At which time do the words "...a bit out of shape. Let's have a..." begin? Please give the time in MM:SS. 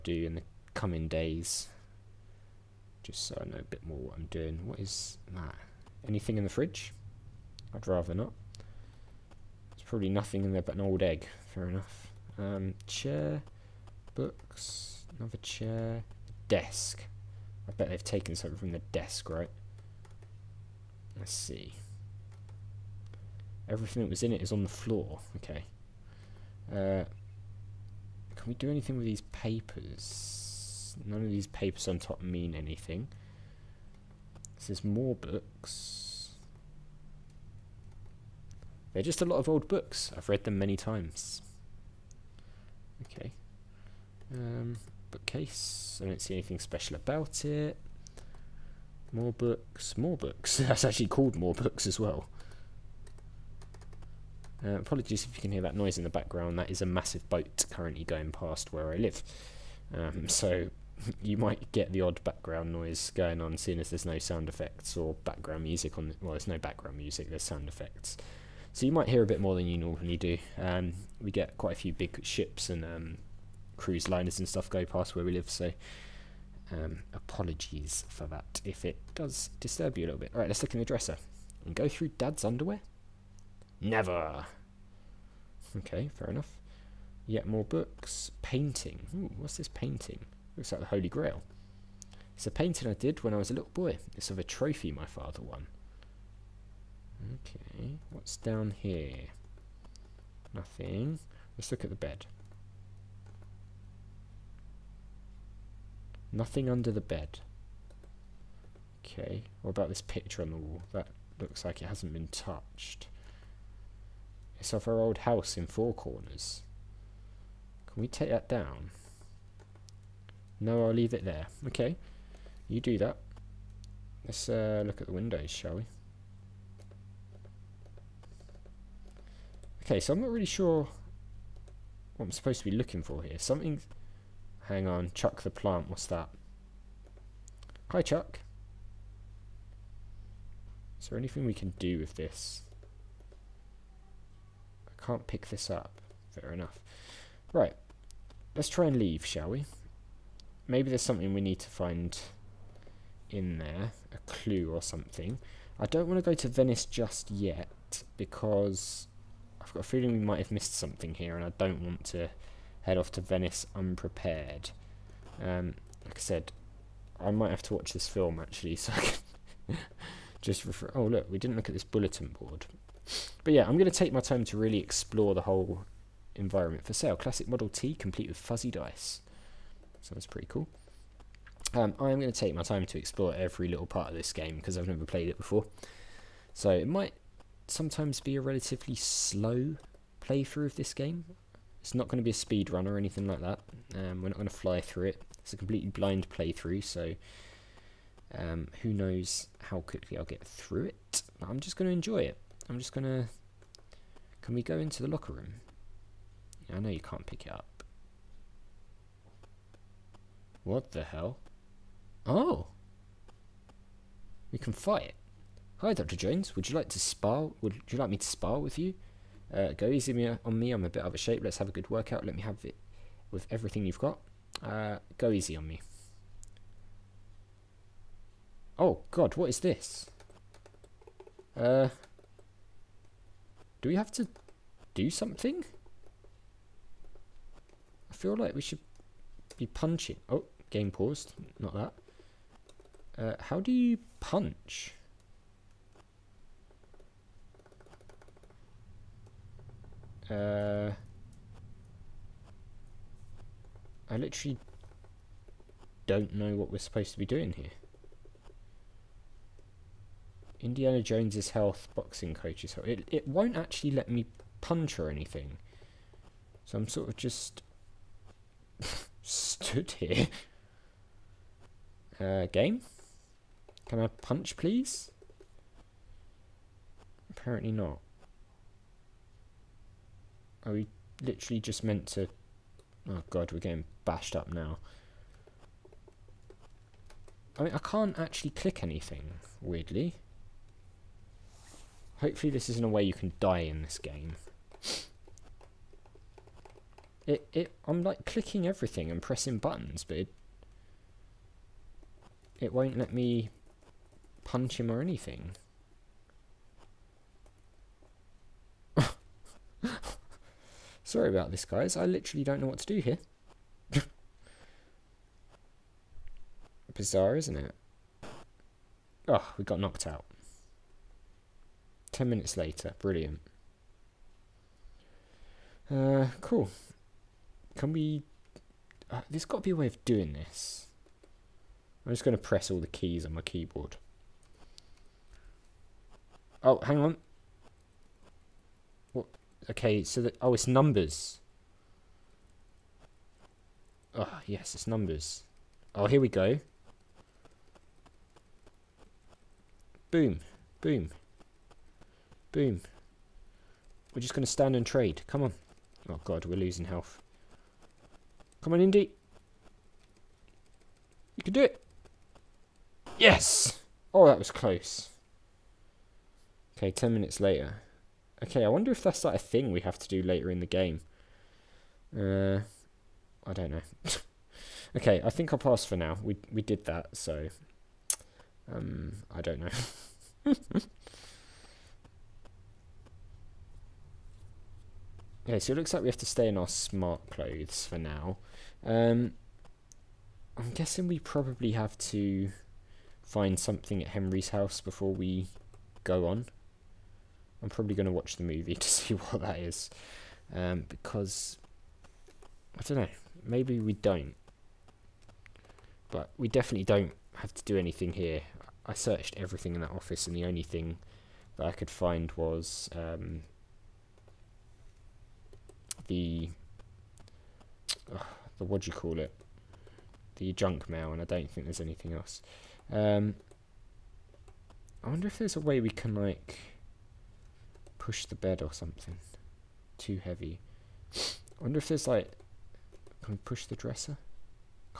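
03:40.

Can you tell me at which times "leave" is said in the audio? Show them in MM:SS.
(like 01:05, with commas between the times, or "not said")
02:00, 02:28.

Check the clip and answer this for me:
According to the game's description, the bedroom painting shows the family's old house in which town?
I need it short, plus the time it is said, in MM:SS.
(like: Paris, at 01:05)
Four Corners, at 01:55.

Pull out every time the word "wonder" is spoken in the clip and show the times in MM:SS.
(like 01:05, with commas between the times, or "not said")
06:08, 07:05, 07:11.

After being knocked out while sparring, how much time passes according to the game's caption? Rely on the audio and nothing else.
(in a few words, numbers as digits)
10 minutes.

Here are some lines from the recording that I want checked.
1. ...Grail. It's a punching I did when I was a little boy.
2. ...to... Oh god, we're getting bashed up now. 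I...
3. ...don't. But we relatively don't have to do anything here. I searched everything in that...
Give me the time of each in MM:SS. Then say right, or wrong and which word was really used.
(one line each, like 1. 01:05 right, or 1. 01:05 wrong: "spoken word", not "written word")
1. 01:31 wrong: "painting", not "punching"
2. 04:42 right
3. 06:43 wrong: "definitely", not "relatively".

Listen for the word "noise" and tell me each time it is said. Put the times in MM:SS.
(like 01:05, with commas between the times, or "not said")
00:55, 01:02.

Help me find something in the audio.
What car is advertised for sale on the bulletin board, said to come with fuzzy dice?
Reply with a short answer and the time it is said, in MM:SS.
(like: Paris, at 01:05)
Model T, at 02:57.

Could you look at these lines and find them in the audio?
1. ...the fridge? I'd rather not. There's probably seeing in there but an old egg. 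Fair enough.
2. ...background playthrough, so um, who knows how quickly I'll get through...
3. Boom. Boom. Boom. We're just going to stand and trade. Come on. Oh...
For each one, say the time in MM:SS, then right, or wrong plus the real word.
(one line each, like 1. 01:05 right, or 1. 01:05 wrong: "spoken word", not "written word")
1. 00:06 wrong: "nothing", not "seeing"
2. 03:15 wrong: "blind", not "background"
3. 05:50 right.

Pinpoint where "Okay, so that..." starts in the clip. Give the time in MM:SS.
05:39.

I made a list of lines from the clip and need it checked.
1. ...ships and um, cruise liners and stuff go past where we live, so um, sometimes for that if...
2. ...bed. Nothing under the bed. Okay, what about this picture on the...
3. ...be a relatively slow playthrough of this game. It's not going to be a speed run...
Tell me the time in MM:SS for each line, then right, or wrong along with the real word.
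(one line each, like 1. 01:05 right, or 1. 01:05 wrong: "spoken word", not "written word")
1. 01:12 wrong: "apologies", not "sometimes"
2. 01:41 right
3. 03:08 right.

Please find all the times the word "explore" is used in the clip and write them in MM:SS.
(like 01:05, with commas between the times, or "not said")
02:54, 03:02.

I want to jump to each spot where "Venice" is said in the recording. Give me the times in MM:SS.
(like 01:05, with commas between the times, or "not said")
02:36, 02:43.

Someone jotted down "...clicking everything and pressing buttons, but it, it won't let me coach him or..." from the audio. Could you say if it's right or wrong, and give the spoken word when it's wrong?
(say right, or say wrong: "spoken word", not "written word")
wrong: "punch", not "coach".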